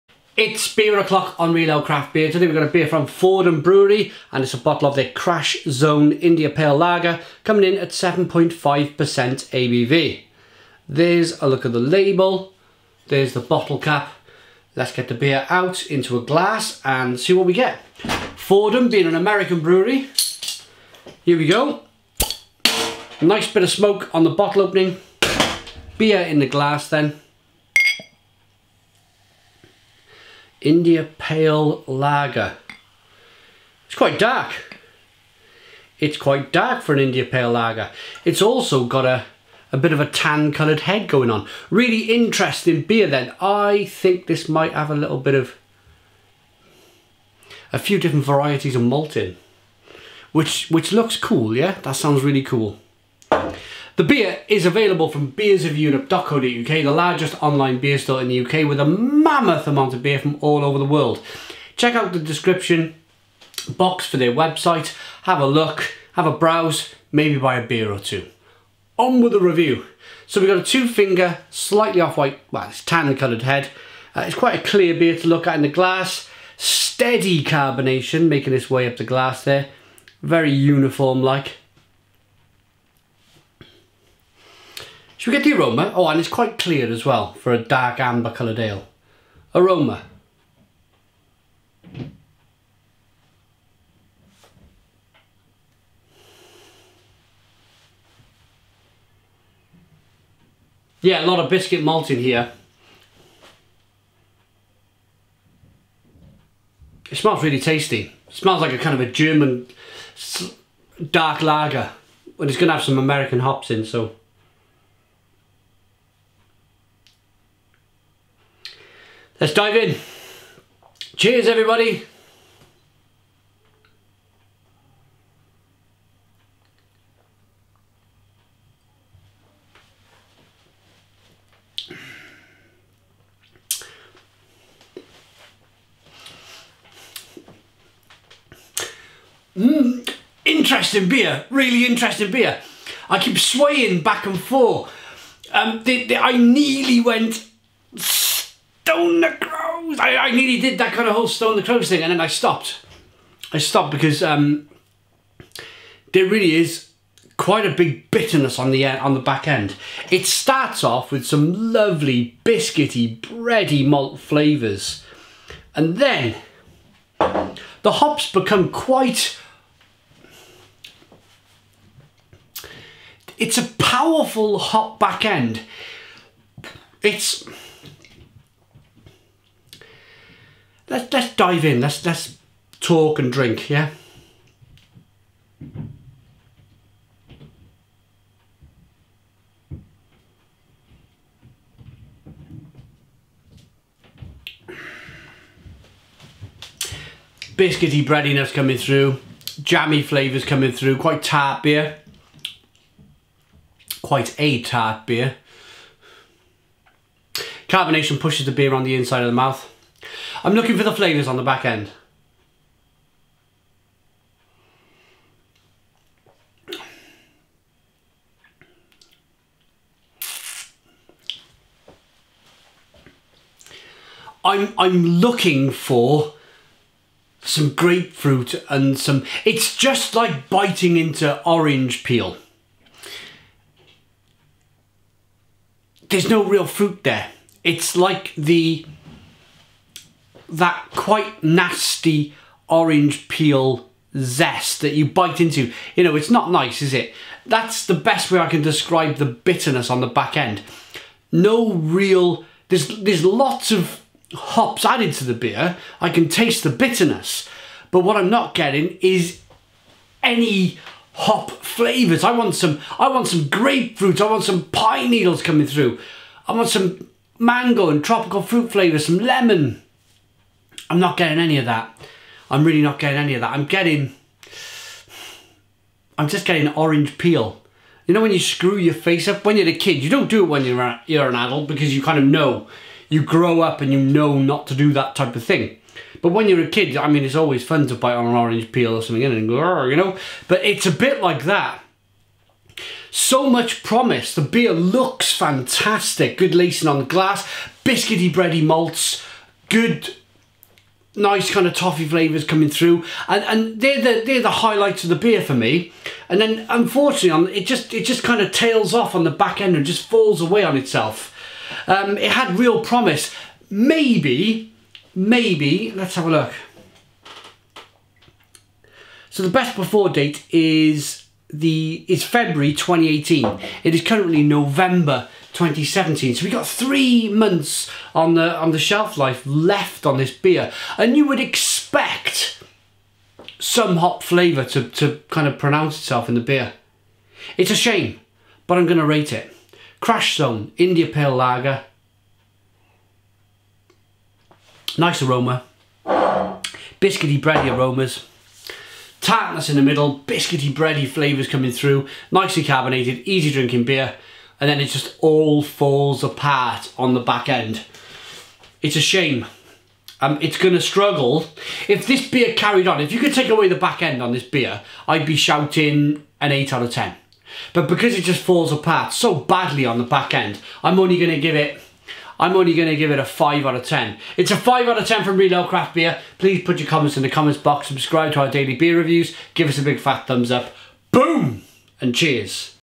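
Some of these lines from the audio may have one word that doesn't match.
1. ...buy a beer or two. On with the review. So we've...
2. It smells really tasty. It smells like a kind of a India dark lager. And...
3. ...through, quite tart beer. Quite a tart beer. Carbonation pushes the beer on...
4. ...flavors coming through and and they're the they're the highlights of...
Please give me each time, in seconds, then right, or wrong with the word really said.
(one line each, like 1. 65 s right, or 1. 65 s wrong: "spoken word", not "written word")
1. 67 s right
2. 107 s wrong: "German", not "India"
3. 200 s right
4. 302 s right.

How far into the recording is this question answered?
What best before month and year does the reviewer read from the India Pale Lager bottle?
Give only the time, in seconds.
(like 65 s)
322 s.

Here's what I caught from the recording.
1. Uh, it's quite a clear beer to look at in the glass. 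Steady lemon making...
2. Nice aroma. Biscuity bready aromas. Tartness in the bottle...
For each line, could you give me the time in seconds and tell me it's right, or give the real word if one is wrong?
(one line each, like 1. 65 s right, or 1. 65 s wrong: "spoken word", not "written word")
1. 74 s wrong: "carbonation", not "lemon"
2. 344 s wrong: "middle", not "bottle".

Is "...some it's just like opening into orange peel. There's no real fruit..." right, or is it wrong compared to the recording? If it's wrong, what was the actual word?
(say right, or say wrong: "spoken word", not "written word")
wrong: "biting", not "opening".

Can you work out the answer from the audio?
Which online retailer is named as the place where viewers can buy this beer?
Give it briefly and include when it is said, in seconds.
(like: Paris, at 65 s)
beersofeurope.co.uk, at 55 s.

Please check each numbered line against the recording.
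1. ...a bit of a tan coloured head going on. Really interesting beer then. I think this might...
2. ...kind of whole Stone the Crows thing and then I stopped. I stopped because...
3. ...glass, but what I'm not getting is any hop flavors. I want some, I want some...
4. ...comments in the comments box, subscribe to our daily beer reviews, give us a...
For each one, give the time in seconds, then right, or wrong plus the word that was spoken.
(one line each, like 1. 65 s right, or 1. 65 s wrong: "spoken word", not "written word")
1. 39 s right
2. 150 s right
3. 256 s wrong: "bitterness", not "glass"
4. 376 s right.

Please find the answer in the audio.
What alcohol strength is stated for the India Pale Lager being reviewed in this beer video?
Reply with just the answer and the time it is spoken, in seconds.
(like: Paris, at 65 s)
7.5%, at 7 s.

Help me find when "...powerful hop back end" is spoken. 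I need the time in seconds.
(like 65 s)
173 s.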